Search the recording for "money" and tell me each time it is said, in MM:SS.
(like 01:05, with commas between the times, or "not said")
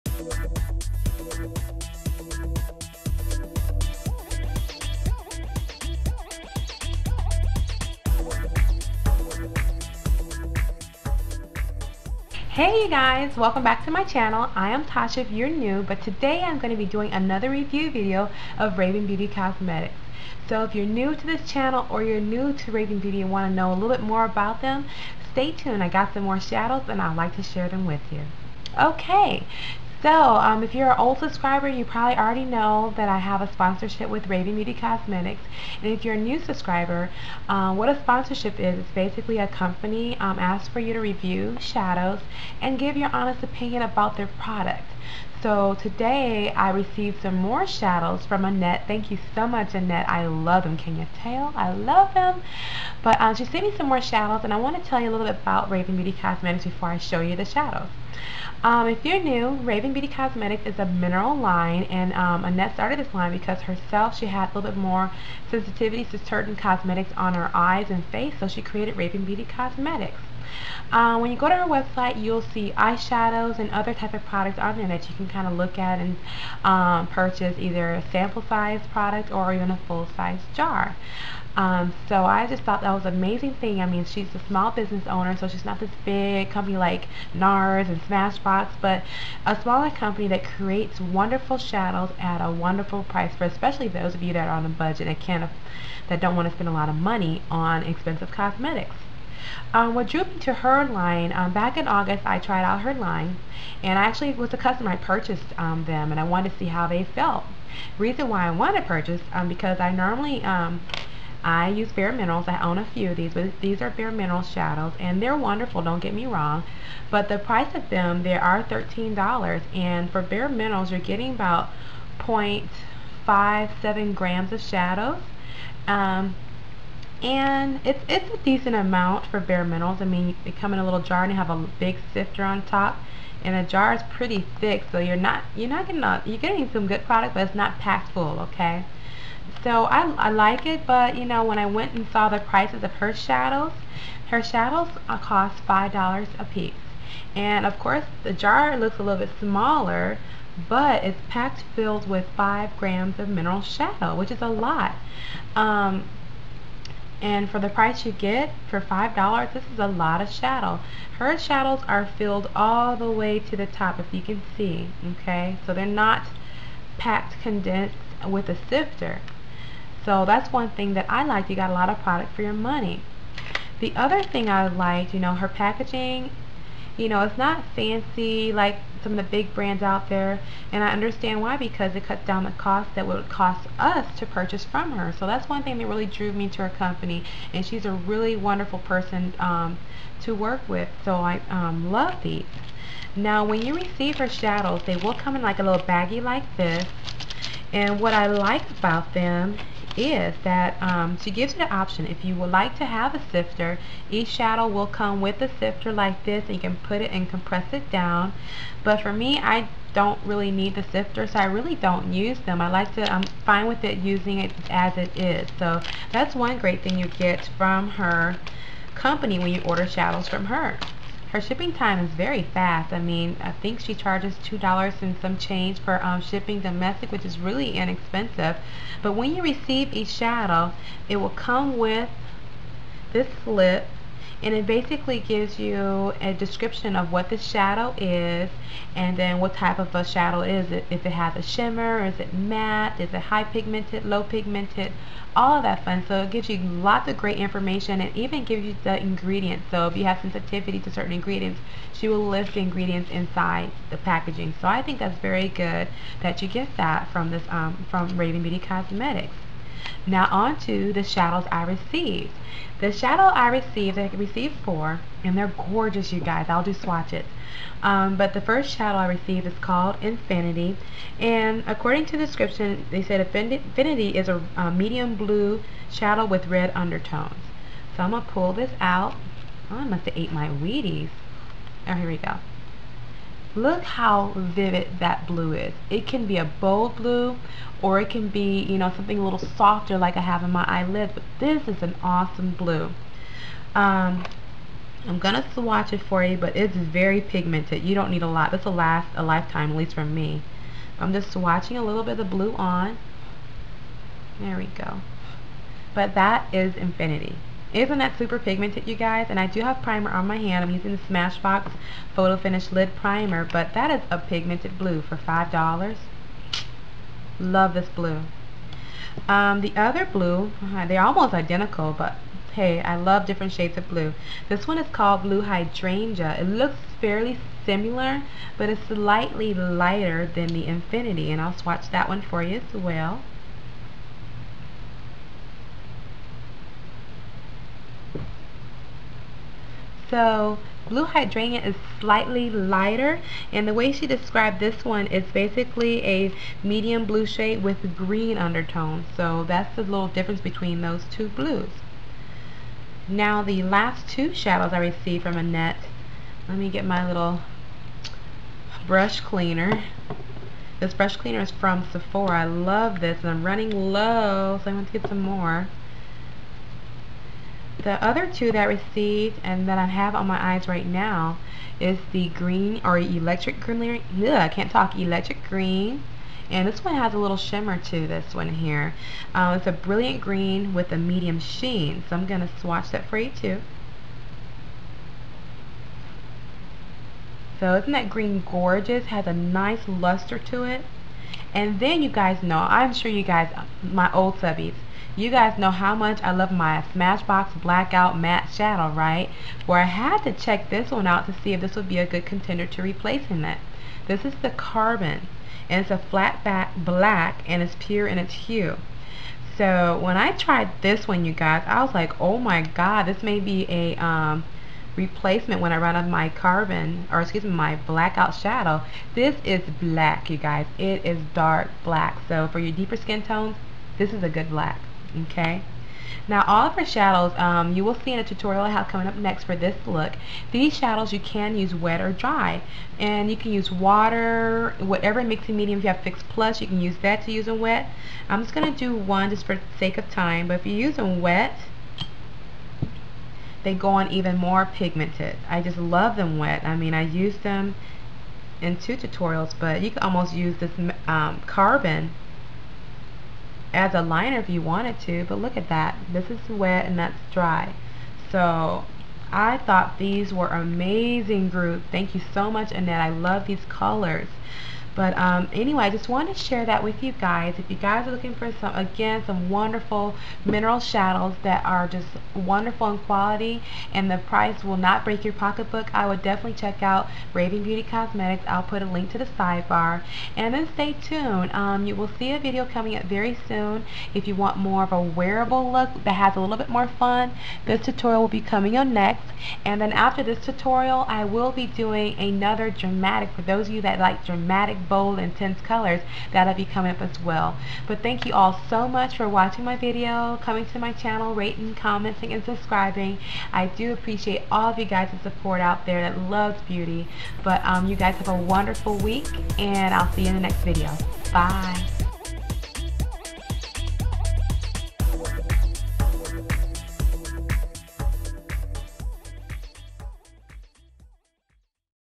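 01:36, 02:52.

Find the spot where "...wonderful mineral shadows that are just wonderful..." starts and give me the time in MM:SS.
07:49.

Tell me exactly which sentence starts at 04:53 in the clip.
Um, I'm going to swatch it for you, but it's very pigmented.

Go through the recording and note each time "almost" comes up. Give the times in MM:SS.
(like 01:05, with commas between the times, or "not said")
05:21, 07:30.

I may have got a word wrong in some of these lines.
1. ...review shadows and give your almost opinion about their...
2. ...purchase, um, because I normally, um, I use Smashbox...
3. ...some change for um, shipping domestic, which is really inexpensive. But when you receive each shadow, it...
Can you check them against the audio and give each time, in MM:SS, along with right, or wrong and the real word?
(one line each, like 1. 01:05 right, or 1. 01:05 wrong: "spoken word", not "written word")
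1. 00:40 wrong: "honest", not "almost"
2. 01:48 wrong: "Bare", not "Smashbox"
3. 03:45 right.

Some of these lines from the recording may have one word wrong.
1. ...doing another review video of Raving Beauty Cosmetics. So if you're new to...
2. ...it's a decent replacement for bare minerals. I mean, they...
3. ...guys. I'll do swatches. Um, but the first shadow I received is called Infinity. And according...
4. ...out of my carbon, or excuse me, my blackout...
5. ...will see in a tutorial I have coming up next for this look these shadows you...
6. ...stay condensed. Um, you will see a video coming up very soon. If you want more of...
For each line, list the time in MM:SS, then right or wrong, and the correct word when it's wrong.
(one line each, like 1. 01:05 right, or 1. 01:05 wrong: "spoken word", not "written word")
1. 00:16 right
2. 02:08 wrong: "amount", not "replacement"
3. 04:26 right
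4. 06:55 right
5. 07:07 right
6. 08:00 wrong: "tuned", not "condensed".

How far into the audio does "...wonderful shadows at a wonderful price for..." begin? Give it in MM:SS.
01:31.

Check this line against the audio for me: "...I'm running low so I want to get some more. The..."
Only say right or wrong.
right.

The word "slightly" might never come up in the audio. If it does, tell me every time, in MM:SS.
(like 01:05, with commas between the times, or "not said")
05:28, 05:42.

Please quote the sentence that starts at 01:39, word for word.
Um, what drew me to her line, um, back in August, I tried out her line, and I actually was a customer.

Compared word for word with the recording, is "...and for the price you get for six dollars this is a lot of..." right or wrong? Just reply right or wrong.
wrong.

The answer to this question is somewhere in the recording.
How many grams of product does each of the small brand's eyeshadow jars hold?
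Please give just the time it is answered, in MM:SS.
02:32.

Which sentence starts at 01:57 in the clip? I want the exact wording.
But the price of them, they are $13, and for Bare Minerals, you're getting about 0.57 grams of shadows.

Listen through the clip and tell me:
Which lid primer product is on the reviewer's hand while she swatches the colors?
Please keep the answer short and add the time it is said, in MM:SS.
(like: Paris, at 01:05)
Smashbox Photo Finish Lid Primer, at 05:11.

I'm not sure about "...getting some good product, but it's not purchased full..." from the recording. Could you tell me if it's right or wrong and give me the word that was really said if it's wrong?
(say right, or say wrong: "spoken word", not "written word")
wrong: "packed", not "purchased".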